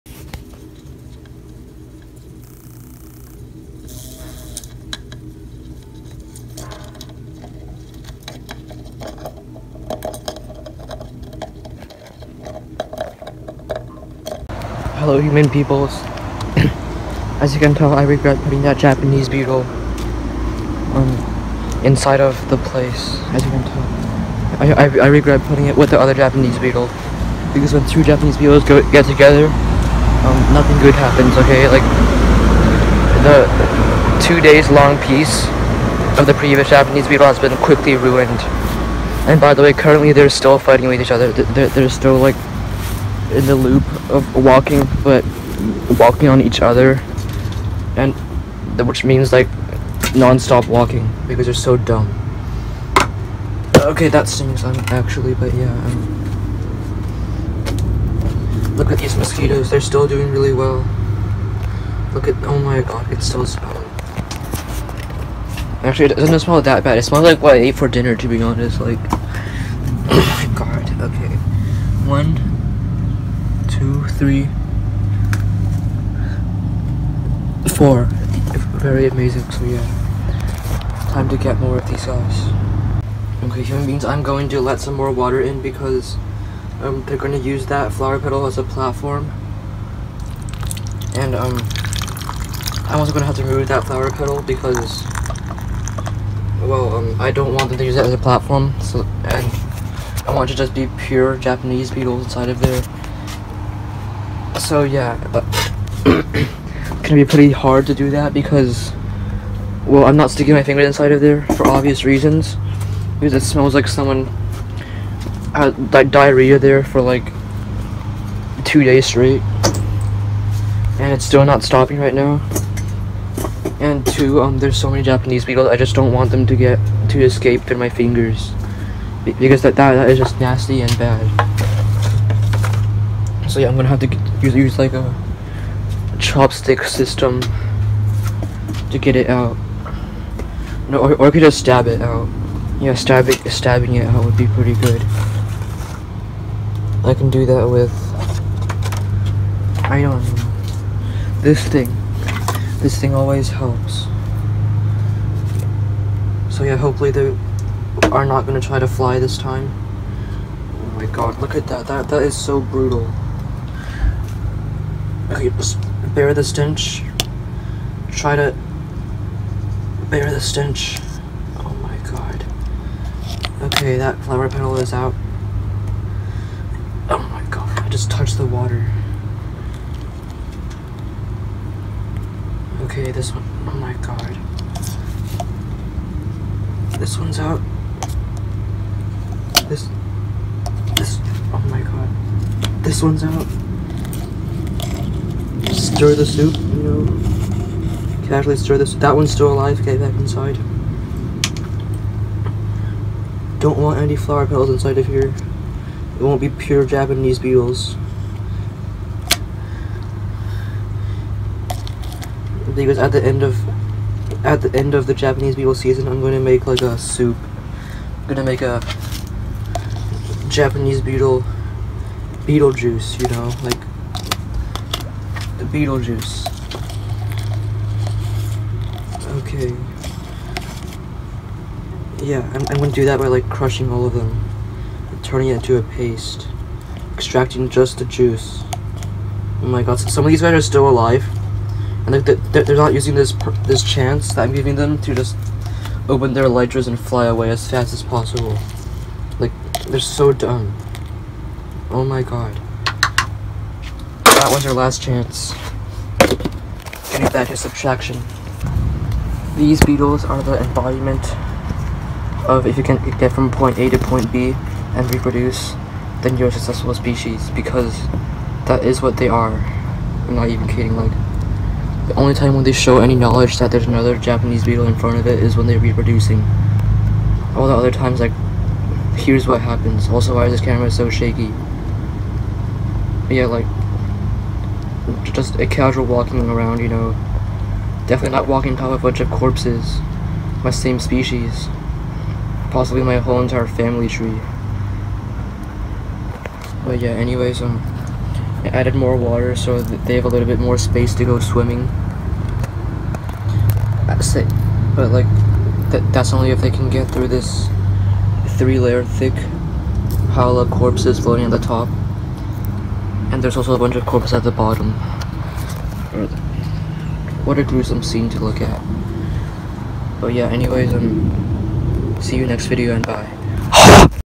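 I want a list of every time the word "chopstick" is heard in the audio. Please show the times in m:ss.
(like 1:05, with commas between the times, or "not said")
2:16.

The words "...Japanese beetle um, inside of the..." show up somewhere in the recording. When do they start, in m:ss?
0:18.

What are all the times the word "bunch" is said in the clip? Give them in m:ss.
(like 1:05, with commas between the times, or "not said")
4:49, 5:13.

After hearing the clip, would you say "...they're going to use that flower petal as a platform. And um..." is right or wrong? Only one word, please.
right.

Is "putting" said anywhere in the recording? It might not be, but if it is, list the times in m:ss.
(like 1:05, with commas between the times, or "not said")
0:18, 0:25.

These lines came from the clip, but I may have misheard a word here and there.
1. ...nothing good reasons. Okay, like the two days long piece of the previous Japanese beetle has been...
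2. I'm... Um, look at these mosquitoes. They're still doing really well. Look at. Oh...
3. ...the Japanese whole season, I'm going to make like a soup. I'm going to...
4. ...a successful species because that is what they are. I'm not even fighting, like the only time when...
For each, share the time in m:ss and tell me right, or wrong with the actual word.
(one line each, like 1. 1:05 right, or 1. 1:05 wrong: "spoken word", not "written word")
1. 0:30 wrong: "happens", not "reasons"
2. 0:55 right
3. 3:35 wrong: "beetle", not "whole"
4. 4:26 wrong: "kidding", not "fighting".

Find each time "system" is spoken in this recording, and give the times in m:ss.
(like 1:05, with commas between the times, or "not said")
2:16.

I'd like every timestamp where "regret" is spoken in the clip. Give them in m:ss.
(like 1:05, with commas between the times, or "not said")
0:18, 0:25.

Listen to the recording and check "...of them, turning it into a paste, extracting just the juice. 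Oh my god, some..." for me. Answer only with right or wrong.
right.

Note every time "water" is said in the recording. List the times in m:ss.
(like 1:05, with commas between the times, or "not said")
1:25, 2:58, 4:59.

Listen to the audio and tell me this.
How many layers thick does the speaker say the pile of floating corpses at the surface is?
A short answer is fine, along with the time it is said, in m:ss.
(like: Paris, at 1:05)
3, at 5:08.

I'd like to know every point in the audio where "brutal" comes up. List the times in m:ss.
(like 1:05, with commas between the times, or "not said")
2:42.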